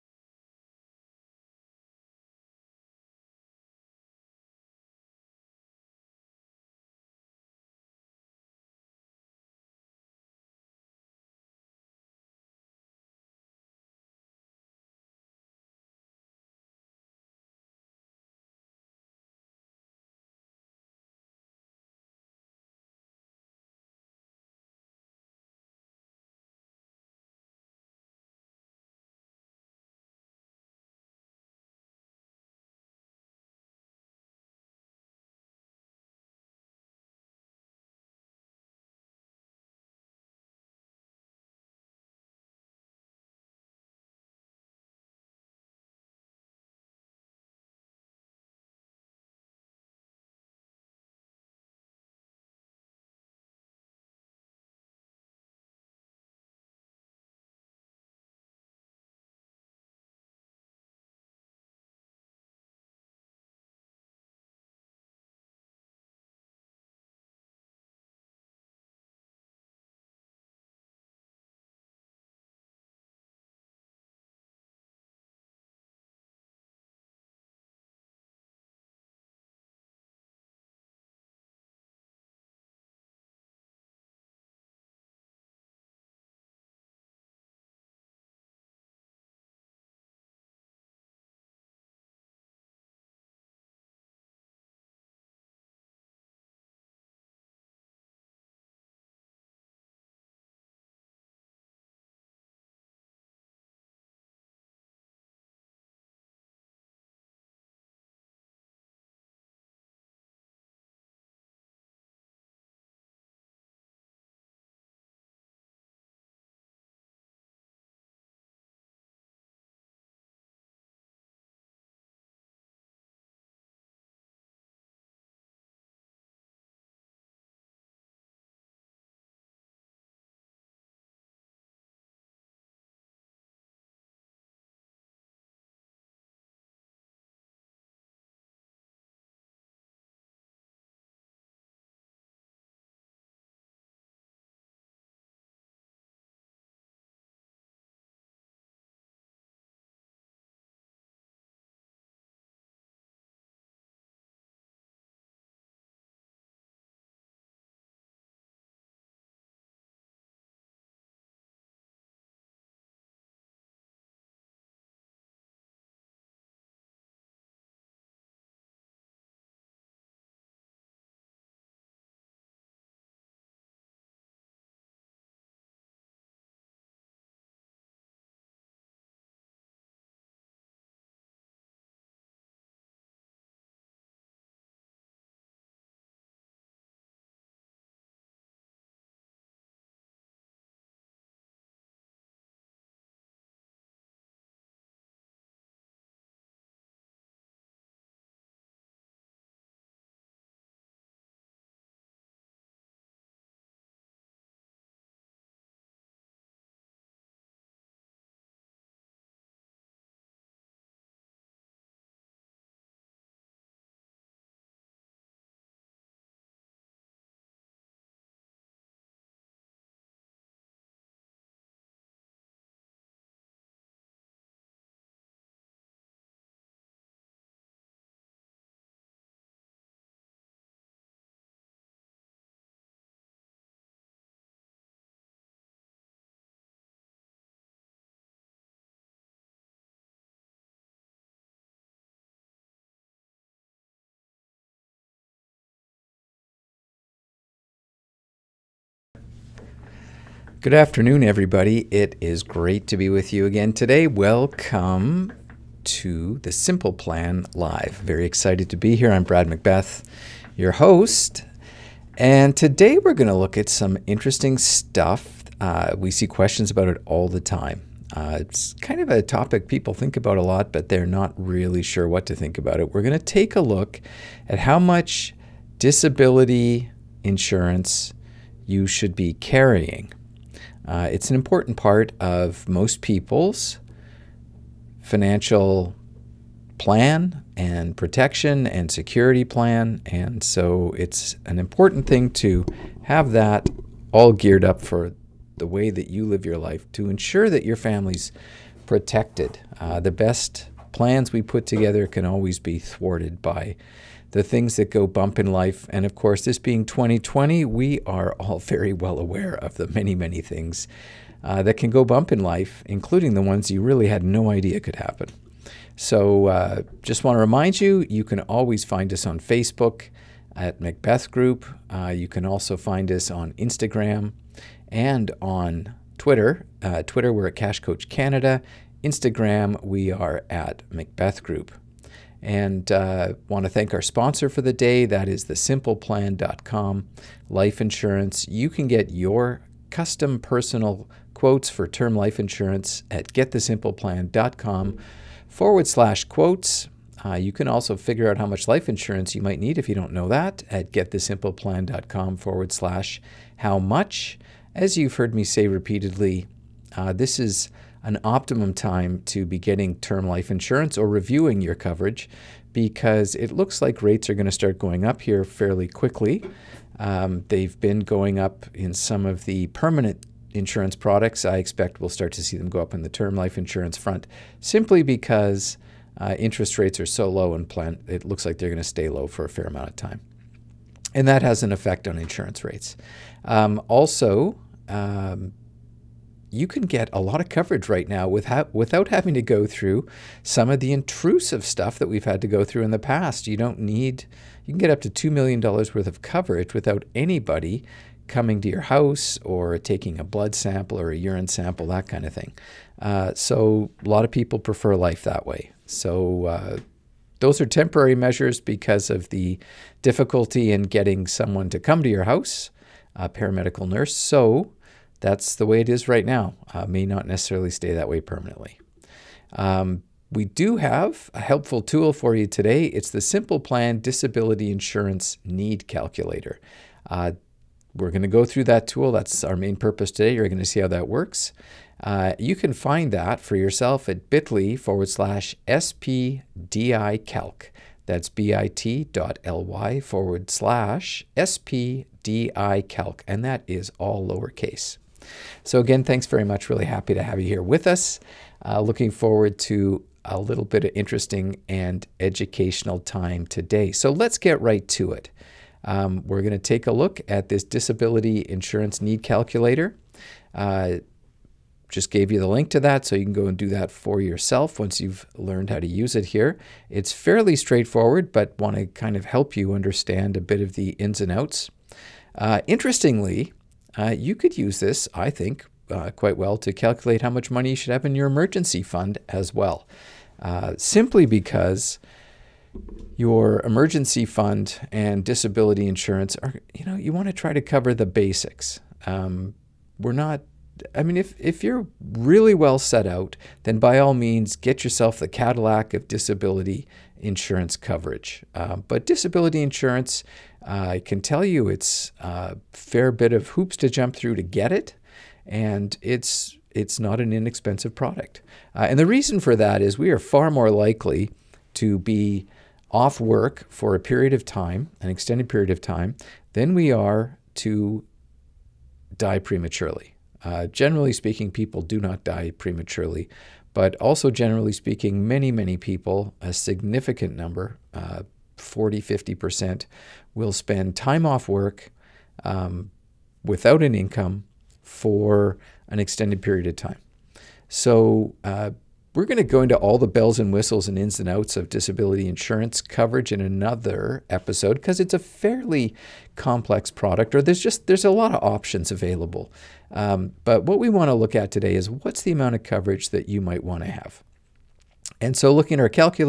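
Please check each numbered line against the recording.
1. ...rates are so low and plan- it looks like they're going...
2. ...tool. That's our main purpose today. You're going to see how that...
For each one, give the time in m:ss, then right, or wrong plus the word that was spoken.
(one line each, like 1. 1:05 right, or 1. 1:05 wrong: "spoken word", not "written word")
1. 6:16 right
2. 7:08 right.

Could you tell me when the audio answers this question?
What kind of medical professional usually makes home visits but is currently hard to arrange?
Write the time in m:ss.
6:53.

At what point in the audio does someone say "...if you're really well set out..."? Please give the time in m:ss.
8:11.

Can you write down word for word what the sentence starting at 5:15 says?
So uh, just want to remind you, you can always find us on Facebook at Macbeth Group.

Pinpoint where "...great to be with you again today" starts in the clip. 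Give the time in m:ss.
4:12.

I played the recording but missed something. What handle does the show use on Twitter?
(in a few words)
Cash Coach Canada.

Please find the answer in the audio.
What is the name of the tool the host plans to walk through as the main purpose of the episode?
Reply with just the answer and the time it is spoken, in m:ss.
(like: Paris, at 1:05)
Simple Plan Disability Insurance Need Calculator, at 7:03.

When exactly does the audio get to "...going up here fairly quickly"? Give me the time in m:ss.
6:04.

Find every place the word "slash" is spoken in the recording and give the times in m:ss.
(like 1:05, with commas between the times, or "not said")
5:45, 5:52, 7:15, 7:20.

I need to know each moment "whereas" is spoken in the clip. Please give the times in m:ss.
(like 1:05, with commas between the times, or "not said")
not said.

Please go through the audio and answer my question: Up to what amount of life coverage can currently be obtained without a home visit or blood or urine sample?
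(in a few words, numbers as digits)
2 million dollars.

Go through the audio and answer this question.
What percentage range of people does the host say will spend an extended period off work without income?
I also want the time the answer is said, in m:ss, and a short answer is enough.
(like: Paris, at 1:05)
40 to 50%, at 8:48.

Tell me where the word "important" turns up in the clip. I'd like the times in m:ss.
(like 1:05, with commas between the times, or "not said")
4:41, 4:51.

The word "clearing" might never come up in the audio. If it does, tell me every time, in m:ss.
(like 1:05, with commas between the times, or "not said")
not said.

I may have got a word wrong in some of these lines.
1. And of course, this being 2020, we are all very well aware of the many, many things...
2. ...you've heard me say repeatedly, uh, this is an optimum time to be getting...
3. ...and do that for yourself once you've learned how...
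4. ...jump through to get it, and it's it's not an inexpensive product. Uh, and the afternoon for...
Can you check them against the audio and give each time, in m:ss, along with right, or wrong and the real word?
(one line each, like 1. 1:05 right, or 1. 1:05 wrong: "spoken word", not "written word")
1. 5:05 right
2. 5:54 right
3. 7:43 right
4. 8:23 wrong: "reason", not "afternoon".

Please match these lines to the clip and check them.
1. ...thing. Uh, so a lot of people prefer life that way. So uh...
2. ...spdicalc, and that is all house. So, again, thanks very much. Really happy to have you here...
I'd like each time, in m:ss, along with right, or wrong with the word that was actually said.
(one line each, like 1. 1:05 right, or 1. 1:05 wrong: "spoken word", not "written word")
1. 6:42 right
2. 7:21 wrong: "lowercase", not "house".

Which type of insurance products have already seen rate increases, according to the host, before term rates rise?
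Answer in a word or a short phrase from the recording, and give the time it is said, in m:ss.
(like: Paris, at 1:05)
permanent insurance products, at 6:09.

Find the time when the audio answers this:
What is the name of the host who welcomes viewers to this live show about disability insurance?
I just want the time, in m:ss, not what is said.
4:19.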